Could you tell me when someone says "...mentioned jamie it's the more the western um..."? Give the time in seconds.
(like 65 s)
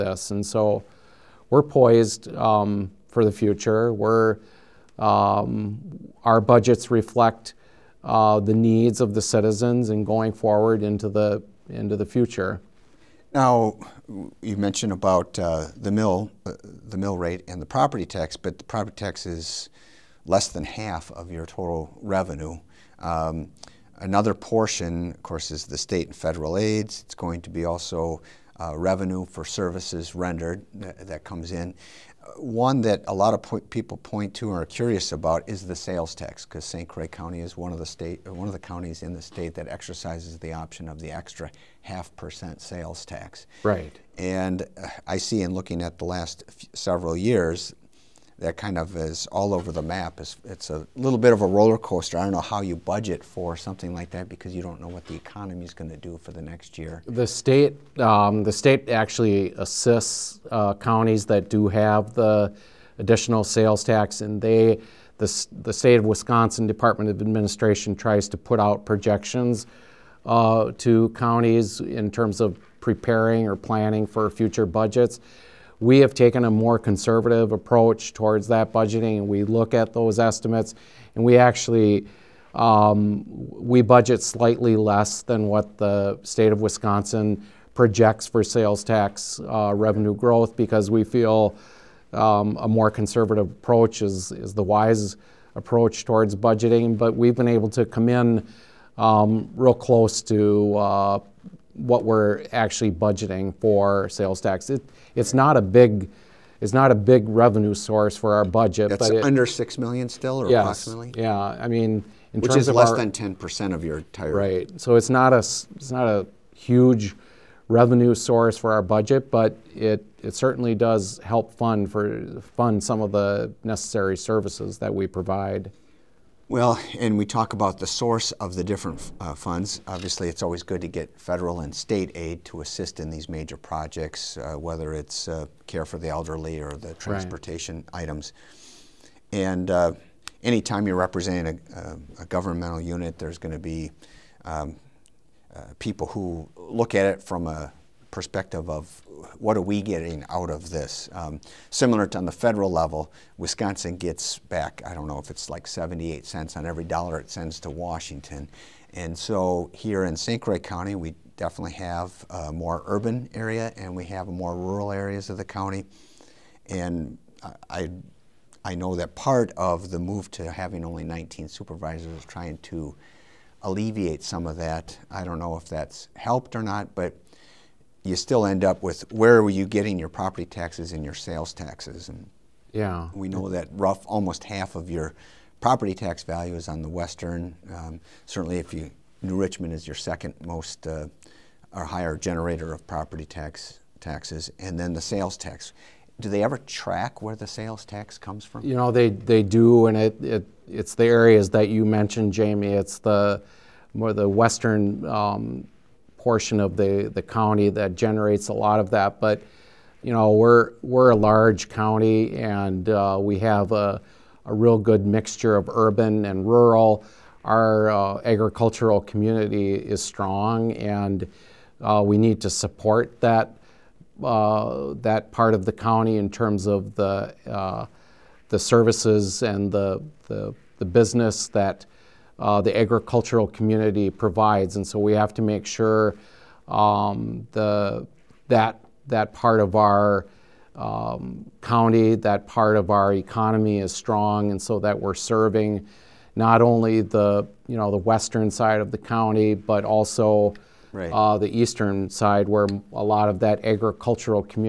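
201 s.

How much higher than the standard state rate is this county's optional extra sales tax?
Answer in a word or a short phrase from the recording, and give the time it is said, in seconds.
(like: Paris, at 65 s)
half percent, at 41 s.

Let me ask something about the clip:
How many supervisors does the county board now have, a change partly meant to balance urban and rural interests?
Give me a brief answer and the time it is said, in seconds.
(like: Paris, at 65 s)
19, at 171 s.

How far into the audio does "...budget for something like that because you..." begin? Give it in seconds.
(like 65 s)
52 s.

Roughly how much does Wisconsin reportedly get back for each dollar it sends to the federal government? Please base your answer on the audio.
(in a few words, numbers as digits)
78 cents.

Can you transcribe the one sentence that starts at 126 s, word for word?
Well, and we talk about the source of the different uh, funds.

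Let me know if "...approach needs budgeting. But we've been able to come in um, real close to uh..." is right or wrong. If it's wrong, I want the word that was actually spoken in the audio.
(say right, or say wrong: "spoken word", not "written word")
wrong: "towards", not "needs".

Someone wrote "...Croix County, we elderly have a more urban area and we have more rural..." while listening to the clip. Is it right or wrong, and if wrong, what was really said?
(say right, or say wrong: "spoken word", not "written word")
wrong: "definitely", not "elderly".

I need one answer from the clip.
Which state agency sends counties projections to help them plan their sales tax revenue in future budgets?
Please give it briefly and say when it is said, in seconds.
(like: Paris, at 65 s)
Department of Administration, at 66 s.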